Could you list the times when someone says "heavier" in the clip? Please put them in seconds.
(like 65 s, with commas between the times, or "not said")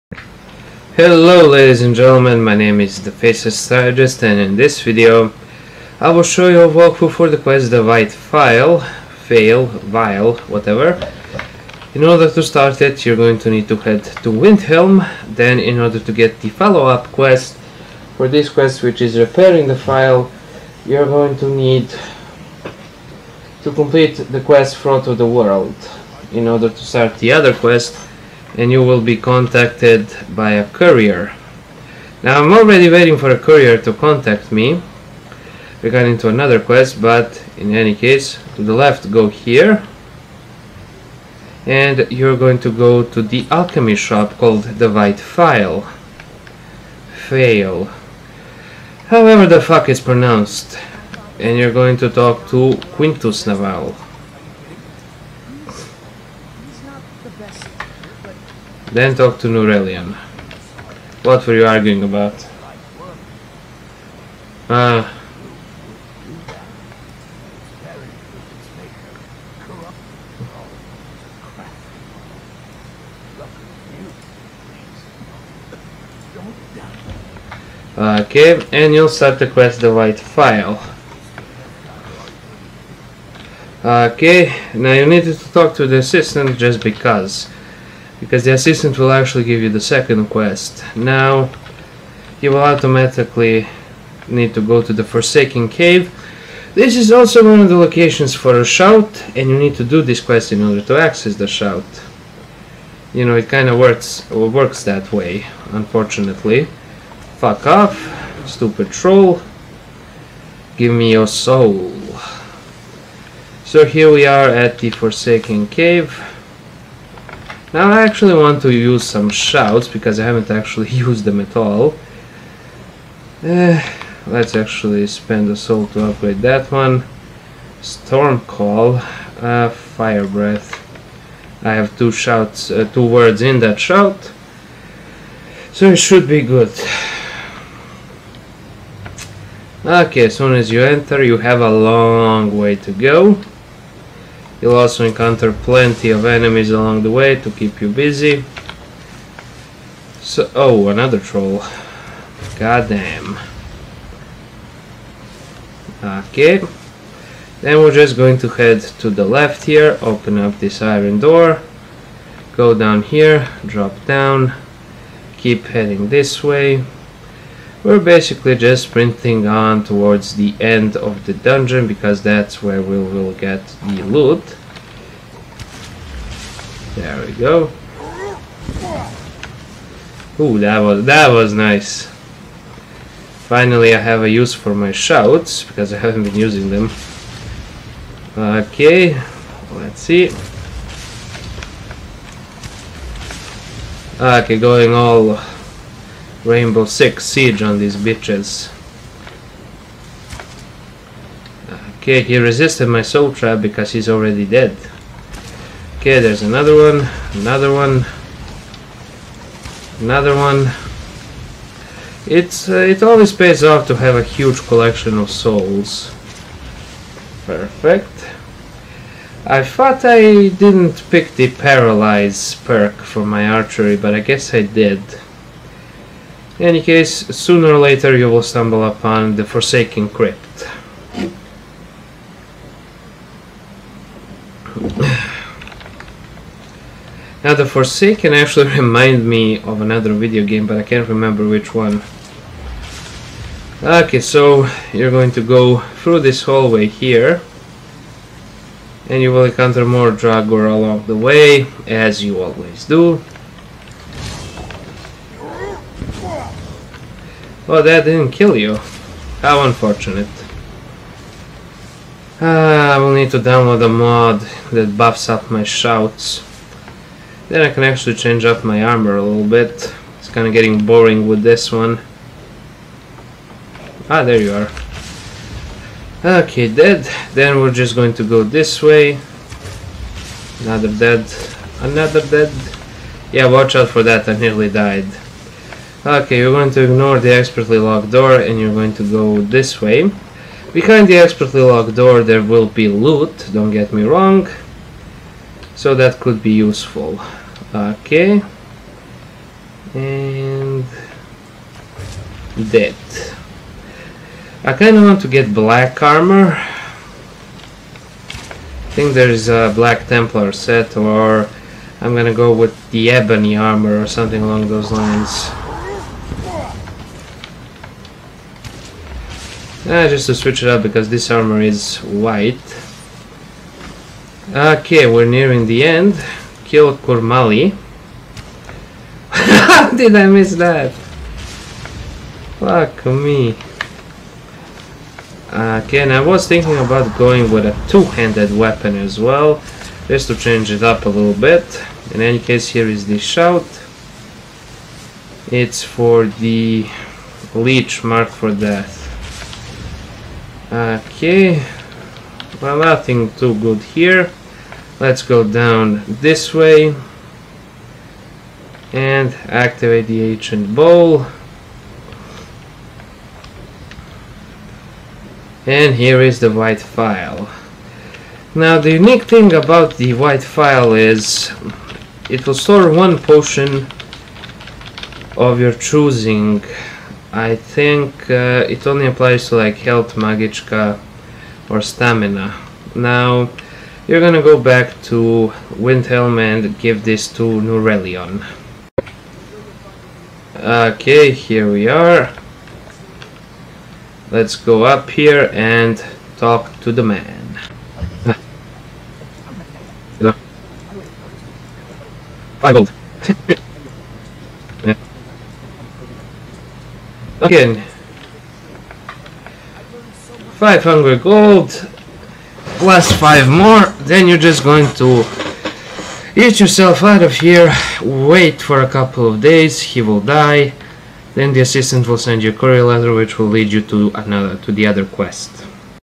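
not said.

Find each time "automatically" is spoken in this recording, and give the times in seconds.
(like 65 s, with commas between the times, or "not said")
92 s.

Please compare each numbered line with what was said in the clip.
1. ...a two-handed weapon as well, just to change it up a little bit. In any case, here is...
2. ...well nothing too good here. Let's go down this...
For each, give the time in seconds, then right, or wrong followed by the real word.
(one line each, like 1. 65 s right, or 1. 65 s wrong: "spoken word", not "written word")
1. 337 s right
2. 352 s right.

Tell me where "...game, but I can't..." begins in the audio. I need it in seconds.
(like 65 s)
240 s.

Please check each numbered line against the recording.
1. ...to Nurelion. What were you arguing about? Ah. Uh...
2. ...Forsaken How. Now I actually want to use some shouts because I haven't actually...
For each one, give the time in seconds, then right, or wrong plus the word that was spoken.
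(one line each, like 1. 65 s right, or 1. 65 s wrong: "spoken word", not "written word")
1. 59 s right
2. 114 s wrong: "Cave", not "How".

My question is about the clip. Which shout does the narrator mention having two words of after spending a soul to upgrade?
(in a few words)
Fire Breath.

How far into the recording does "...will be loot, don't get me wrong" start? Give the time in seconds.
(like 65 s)
292 s.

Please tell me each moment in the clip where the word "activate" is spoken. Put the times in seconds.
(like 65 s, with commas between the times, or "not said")
359 s.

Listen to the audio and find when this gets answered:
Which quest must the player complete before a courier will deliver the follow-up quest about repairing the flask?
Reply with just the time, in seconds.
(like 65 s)
24 s.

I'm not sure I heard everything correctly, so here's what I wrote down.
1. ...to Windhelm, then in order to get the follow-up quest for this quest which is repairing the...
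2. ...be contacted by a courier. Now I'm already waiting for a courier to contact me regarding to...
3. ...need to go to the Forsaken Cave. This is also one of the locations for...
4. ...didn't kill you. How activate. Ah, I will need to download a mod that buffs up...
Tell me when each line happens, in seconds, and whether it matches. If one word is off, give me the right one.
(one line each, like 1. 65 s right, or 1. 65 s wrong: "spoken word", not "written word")
1. 14 s right
2. 29 s right
3. 94 s right
4. 258 s wrong: "unfortunate", not "activate".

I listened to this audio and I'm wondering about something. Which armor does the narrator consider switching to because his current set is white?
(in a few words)
ebony armor.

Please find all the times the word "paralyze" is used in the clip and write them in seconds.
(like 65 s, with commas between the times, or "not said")
221 s.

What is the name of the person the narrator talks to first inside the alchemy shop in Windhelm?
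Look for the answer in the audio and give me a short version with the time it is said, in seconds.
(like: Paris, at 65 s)
Quintus Navale, at 52 s.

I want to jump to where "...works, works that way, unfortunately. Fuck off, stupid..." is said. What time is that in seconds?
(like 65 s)
103 s.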